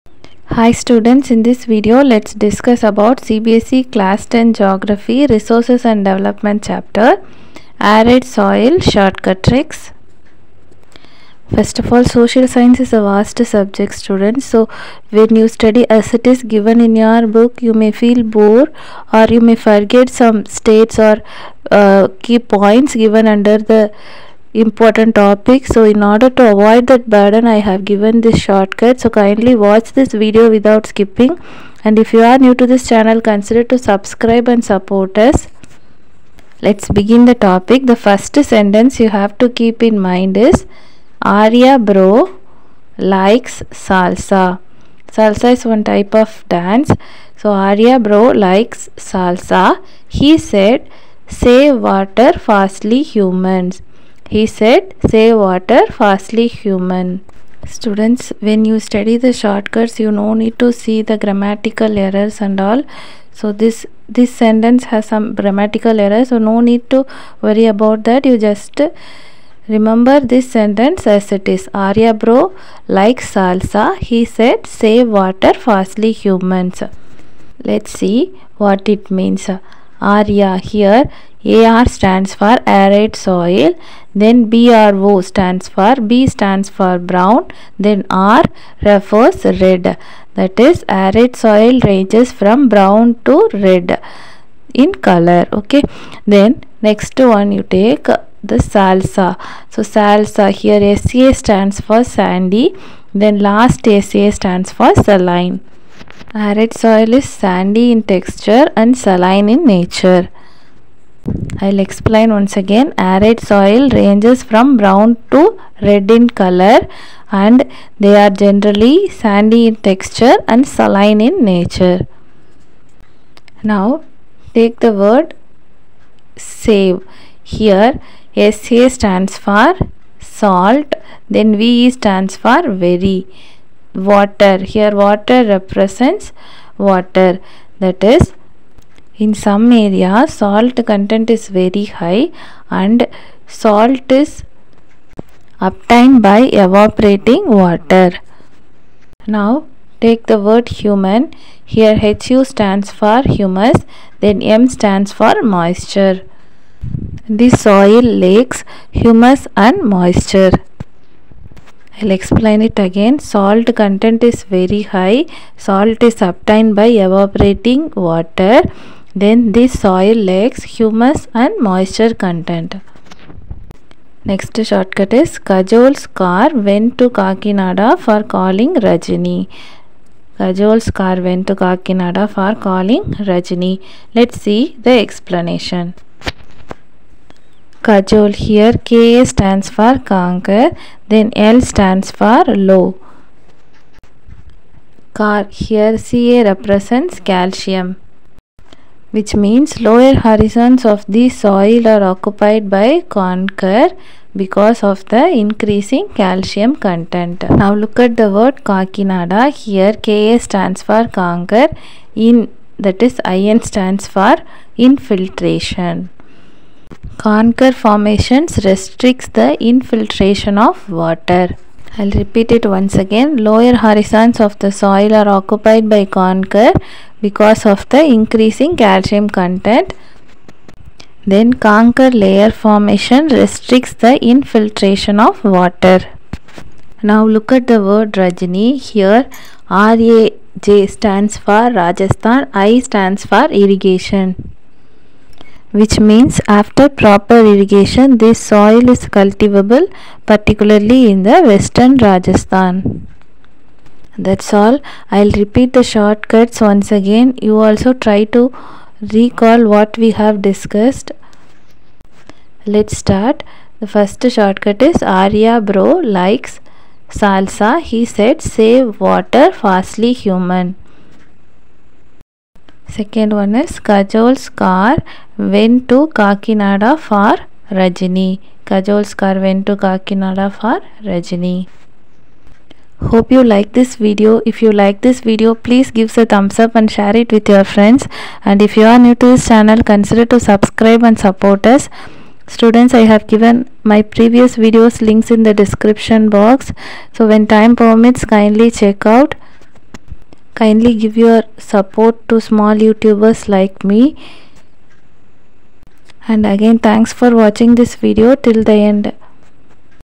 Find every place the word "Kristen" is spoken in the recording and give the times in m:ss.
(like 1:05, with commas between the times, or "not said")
not said.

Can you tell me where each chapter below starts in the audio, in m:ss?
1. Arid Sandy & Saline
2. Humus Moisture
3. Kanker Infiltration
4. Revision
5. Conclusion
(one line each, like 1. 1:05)
1. 0:42
2. 2:11
3. 3:10
4. 4:12
5. 4:43.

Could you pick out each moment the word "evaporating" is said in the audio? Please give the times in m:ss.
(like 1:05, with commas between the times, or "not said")
2:26, 2:47.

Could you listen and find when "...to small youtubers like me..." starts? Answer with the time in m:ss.
5:02.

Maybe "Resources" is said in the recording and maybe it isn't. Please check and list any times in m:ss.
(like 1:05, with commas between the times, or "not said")
0:05.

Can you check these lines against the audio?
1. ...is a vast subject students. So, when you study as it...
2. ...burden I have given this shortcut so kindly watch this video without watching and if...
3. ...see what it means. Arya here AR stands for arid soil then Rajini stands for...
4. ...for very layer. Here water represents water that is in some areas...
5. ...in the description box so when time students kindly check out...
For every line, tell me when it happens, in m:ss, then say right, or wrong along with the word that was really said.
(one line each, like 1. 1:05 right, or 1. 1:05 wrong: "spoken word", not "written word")
1. 0:12 right
2. 0:27 wrong: "skipping", not "watching"
3. 1:18 wrong: "BRO", not "Rajini"
4. 2:12 wrong: "water", not "layer"
5. 4:55 wrong: "permits", not "students".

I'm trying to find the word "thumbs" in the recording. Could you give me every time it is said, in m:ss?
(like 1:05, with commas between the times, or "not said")
4:46.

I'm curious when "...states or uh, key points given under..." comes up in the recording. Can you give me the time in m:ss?
0:20.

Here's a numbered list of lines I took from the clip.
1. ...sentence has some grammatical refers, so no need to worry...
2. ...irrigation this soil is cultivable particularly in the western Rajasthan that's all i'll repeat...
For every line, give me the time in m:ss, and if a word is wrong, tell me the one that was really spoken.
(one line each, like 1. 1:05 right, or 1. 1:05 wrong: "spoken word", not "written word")
1. 1:04 wrong: "errors", not "refers"
2. 4:07 right.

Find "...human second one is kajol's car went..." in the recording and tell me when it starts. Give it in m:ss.
4:30.